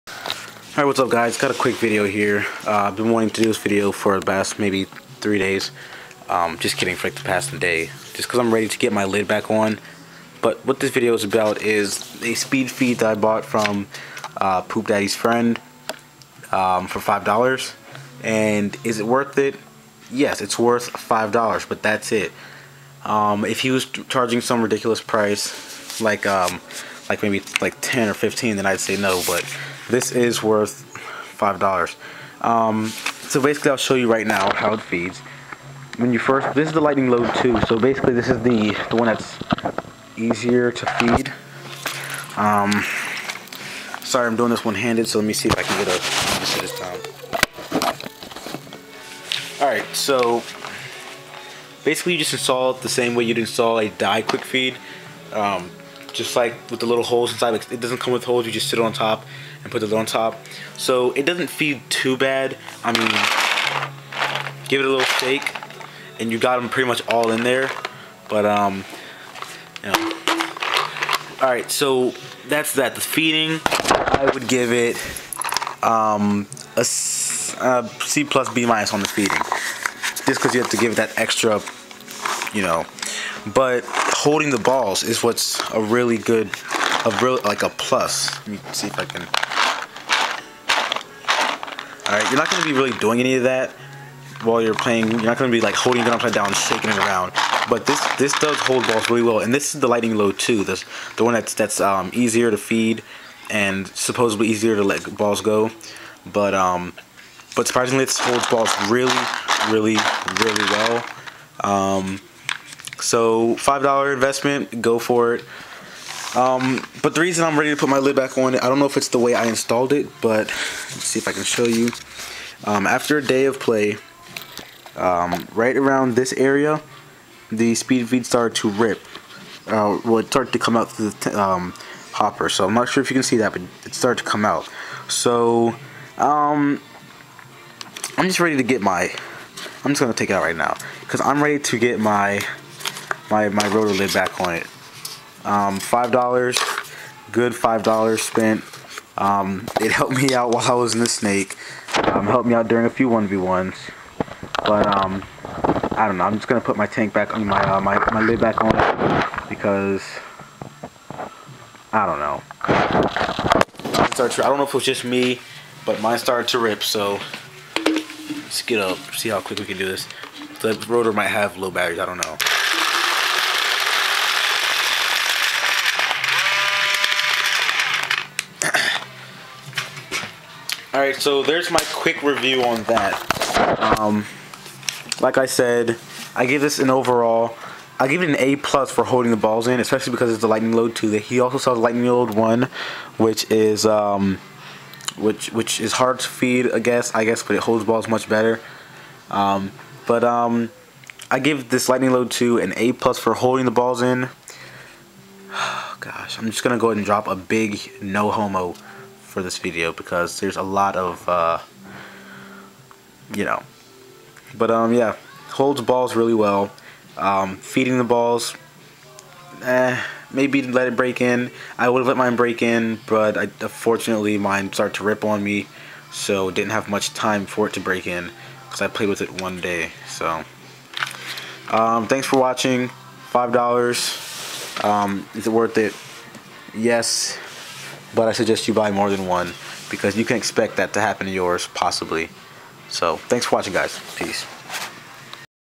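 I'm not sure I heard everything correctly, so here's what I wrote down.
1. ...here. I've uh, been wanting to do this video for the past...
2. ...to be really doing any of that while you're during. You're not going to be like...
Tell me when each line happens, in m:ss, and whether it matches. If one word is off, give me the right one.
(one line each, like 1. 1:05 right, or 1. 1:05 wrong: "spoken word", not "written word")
1. 0:02 right
2. 1:32 wrong: "playing", not "during".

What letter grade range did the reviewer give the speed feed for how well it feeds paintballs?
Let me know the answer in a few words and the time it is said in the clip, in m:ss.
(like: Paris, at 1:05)
C plus B minus, at 1:17.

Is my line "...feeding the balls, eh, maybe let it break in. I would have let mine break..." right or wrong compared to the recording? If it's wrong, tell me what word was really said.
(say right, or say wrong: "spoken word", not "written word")
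right.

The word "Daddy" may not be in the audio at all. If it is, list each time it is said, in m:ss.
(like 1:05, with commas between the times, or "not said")
0:14.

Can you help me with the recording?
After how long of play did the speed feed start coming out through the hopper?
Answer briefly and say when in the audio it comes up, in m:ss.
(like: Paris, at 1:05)
a day, at 2:03.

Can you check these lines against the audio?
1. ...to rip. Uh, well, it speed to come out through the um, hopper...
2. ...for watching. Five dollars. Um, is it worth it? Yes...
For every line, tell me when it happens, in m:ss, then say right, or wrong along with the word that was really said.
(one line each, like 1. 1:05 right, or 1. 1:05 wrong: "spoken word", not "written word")
1. 2:08 wrong: "started", not "speed"
2. 3:52 right.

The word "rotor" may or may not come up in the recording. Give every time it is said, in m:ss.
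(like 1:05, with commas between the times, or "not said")
2:23, 2:50.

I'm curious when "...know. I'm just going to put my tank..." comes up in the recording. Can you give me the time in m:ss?
2:36.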